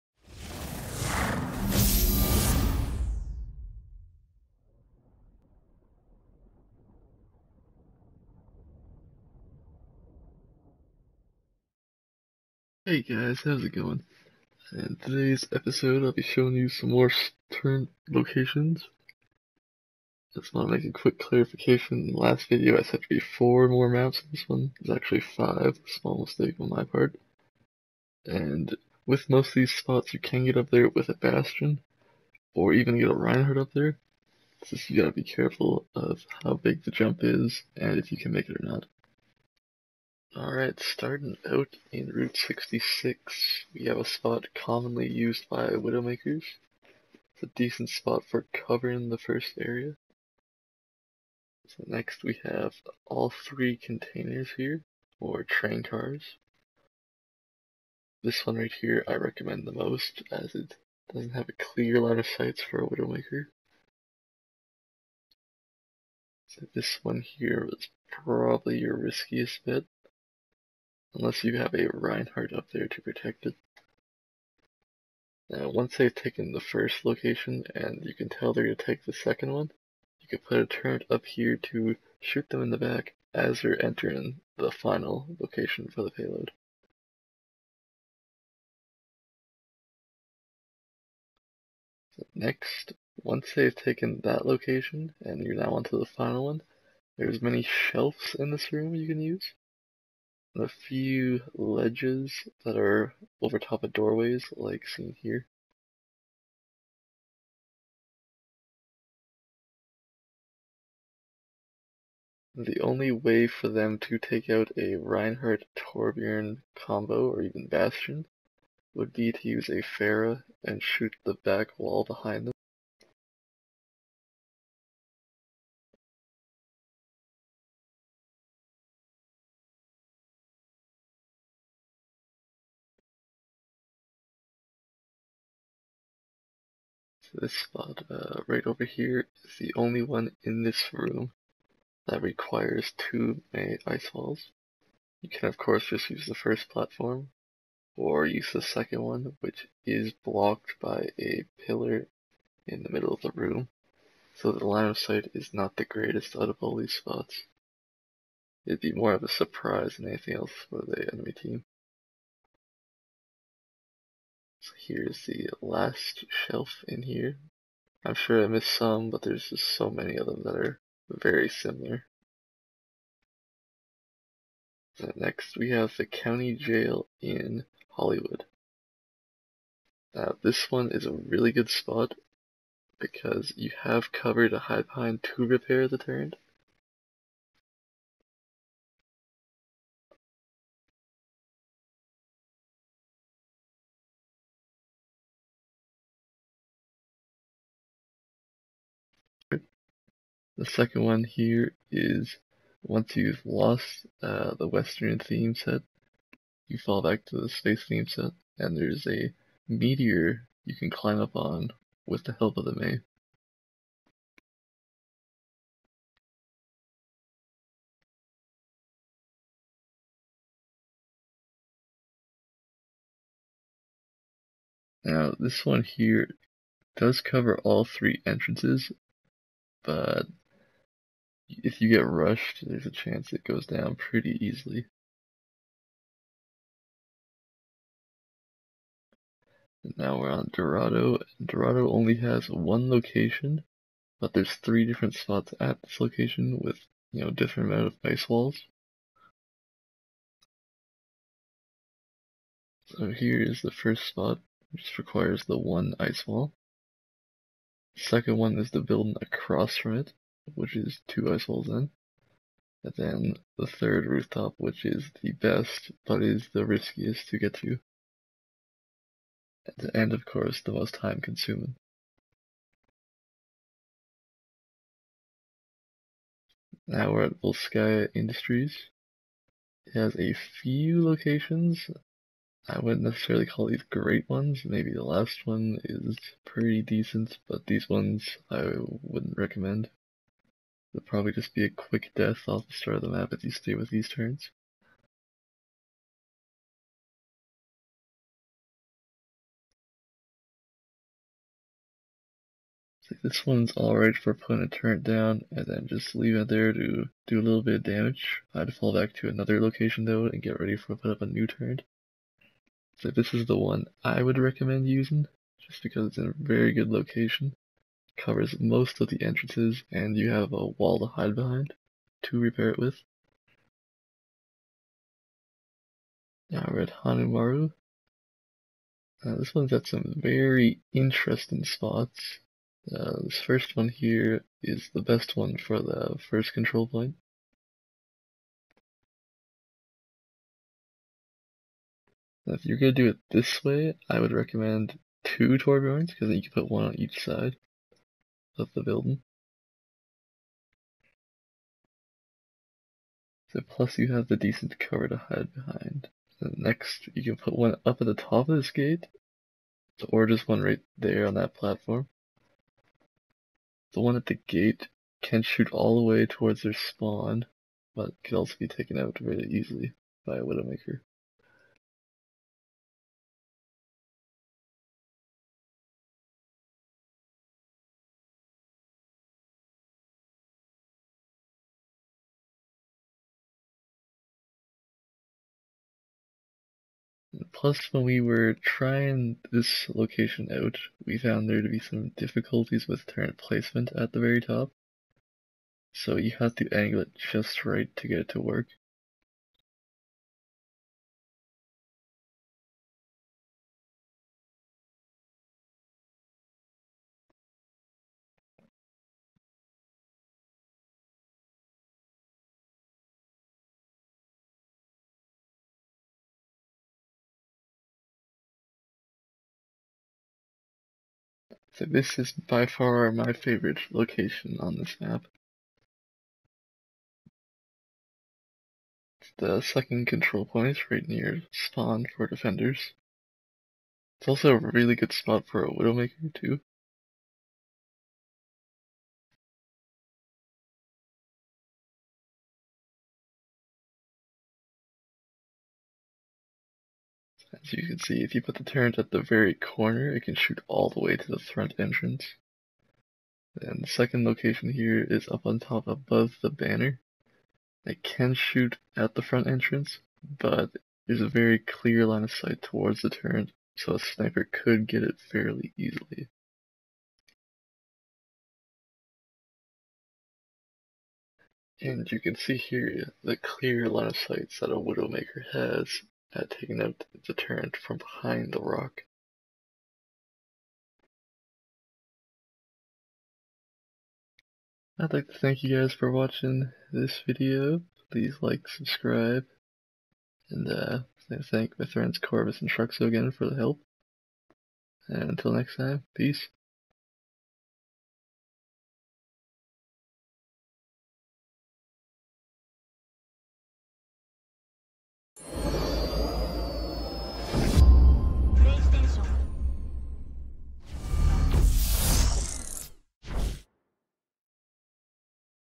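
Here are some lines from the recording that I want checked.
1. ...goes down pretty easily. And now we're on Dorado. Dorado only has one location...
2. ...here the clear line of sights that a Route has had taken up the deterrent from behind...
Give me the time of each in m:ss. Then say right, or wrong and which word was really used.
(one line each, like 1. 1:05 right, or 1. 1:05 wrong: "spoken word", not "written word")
1. 3:53 right
2. 7:52 wrong: "Widowmaker", not "Route".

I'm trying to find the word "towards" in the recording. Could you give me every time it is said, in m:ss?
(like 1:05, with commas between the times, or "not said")
6:06, 7:42.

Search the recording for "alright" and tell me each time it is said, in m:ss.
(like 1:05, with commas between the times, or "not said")
0:40, 5:03.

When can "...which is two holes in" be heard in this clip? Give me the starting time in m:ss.
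4:20.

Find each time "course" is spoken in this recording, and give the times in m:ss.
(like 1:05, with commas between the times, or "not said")
2:25, 4:30.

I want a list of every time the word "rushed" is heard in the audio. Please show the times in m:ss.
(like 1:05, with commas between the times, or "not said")
3:52.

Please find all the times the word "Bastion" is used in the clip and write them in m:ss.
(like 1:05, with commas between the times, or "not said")
0:31, 1:57.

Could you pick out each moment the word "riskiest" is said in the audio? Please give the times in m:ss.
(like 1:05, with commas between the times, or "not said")
1:08, 4:26.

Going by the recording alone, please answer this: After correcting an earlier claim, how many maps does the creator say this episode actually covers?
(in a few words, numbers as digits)
5.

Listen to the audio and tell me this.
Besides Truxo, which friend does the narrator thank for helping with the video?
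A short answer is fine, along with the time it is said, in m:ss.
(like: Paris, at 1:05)
Corvus, at 8:12.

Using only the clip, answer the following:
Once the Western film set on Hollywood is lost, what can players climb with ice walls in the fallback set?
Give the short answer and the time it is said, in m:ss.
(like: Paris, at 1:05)
A meteor, at 3:29.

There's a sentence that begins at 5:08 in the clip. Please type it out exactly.
I would fall back to another location though and get ready for put up a new turret.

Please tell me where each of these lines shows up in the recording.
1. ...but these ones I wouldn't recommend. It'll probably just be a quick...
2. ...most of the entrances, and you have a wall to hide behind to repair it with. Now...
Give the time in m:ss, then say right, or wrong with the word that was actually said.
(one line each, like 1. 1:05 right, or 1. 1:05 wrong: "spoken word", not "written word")
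1. 4:47 right
2. 5:18 right.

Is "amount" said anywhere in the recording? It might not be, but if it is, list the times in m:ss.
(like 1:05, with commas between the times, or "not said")
4:07.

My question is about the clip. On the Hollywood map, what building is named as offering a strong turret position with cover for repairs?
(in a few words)
County jail.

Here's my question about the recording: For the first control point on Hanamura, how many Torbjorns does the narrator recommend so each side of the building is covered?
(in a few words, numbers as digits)
2.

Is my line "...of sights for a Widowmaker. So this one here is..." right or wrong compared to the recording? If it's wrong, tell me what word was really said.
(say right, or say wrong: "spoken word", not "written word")
right.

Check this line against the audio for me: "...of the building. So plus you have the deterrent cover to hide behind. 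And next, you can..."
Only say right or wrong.
wrong.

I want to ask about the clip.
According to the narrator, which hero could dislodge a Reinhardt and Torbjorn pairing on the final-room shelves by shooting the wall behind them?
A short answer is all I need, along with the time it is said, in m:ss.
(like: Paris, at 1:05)
Pharah, at 1:59.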